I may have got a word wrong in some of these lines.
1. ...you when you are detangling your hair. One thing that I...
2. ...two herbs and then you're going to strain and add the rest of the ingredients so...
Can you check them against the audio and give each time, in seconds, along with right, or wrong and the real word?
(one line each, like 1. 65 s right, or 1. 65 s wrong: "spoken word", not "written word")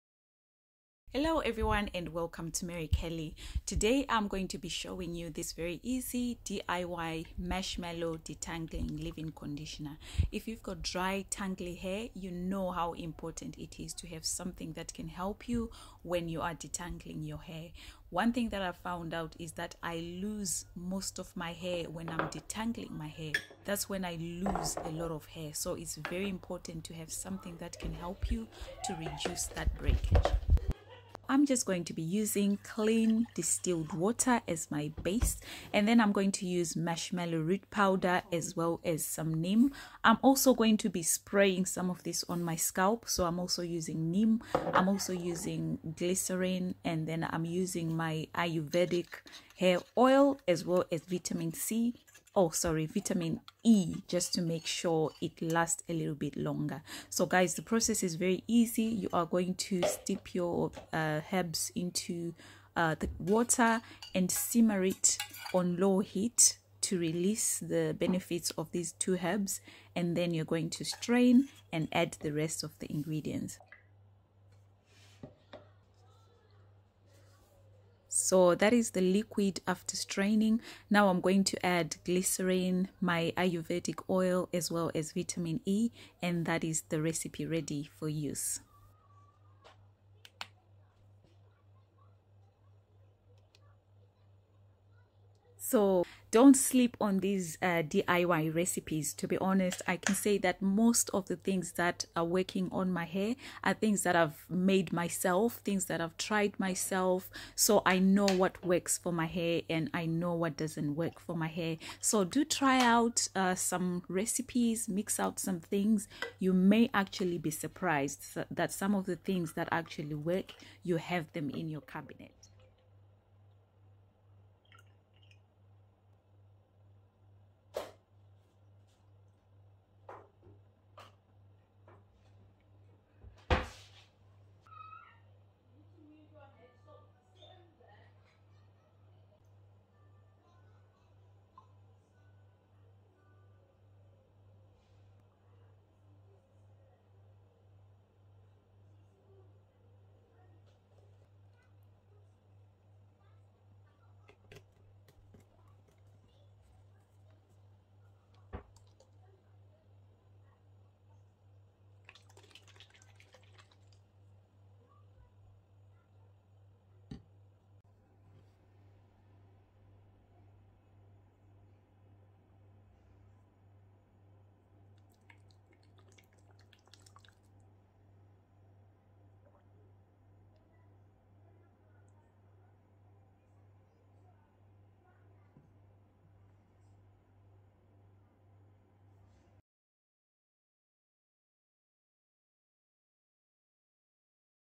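1. 15 s right
2. 68 s right.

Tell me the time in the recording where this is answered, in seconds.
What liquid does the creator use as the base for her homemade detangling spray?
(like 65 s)
32 s.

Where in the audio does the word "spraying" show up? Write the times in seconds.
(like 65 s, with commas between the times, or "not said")
41 s.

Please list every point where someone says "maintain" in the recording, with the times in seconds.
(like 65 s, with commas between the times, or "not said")
not said.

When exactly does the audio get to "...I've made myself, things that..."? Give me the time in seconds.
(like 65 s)
104 s.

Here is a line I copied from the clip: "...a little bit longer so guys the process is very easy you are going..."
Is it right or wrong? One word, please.
right.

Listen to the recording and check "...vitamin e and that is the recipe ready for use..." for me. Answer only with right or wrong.
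right.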